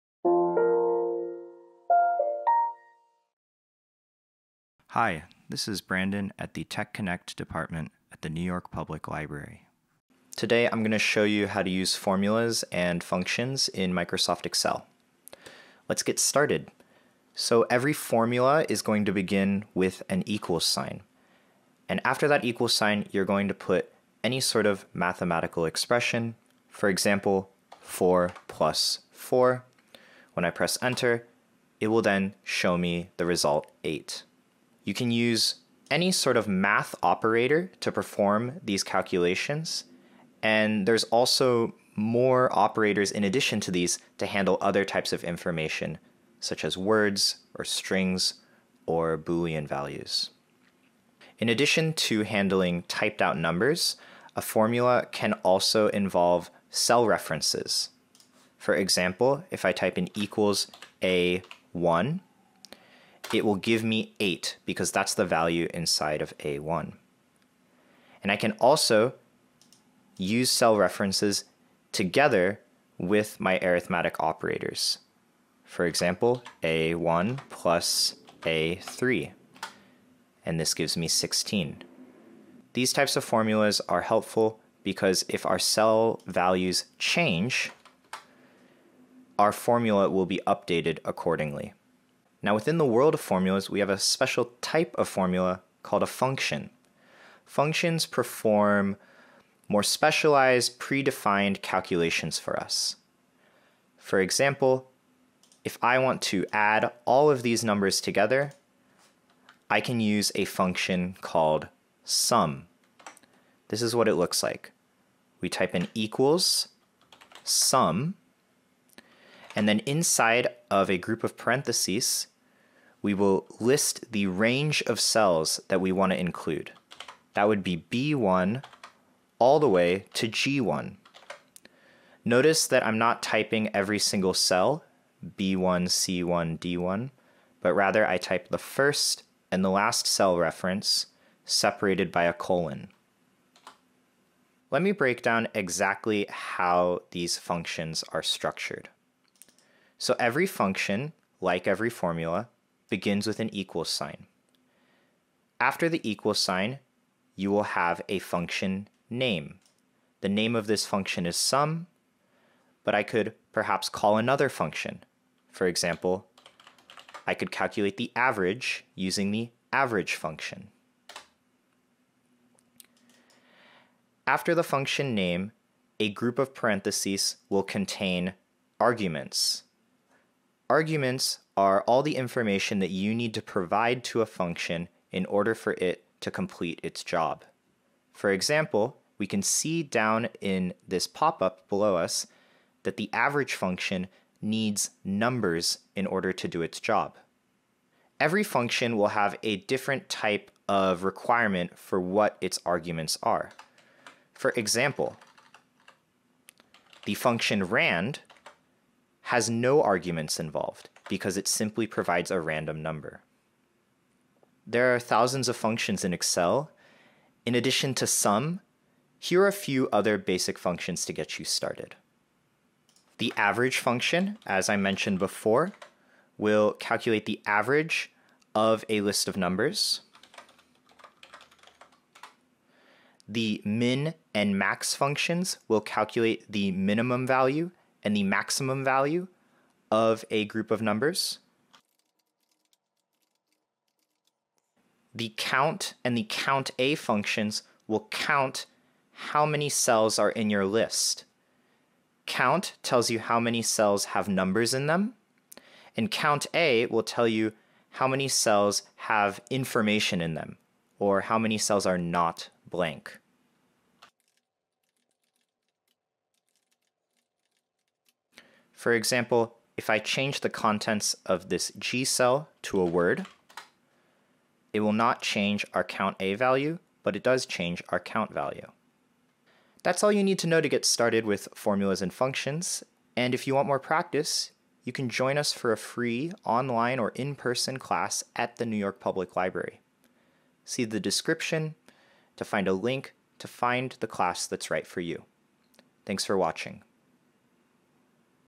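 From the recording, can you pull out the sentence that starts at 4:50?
See the description to find a link to find the class that's right for you.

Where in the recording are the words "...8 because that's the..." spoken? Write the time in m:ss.
1:04.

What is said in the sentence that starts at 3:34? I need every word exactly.
There are thousands of functions in Excel.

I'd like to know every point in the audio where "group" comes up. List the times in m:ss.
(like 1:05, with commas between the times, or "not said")
2:00, 2:56, 4:00.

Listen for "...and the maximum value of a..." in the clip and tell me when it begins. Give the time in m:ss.
3:58.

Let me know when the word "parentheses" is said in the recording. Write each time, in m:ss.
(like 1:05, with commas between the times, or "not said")
2:01, 2:56.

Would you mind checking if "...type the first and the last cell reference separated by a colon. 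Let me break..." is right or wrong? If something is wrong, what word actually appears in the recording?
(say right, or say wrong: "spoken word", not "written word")
right.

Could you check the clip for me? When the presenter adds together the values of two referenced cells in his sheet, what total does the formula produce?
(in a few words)
16.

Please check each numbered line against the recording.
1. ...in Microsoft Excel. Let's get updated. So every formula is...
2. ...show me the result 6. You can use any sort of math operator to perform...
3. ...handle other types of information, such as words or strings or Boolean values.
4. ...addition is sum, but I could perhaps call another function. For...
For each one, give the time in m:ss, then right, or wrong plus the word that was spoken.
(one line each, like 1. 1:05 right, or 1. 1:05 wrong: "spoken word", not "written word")
1. 0:13 wrong: "started", not "updated"
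2. 0:32 wrong: "8", not "6"
3. 0:44 right
4. 2:40 wrong: "function", not "addition".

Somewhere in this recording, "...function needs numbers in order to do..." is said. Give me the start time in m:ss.
3:13.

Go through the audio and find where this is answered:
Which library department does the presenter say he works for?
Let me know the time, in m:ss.
0:06.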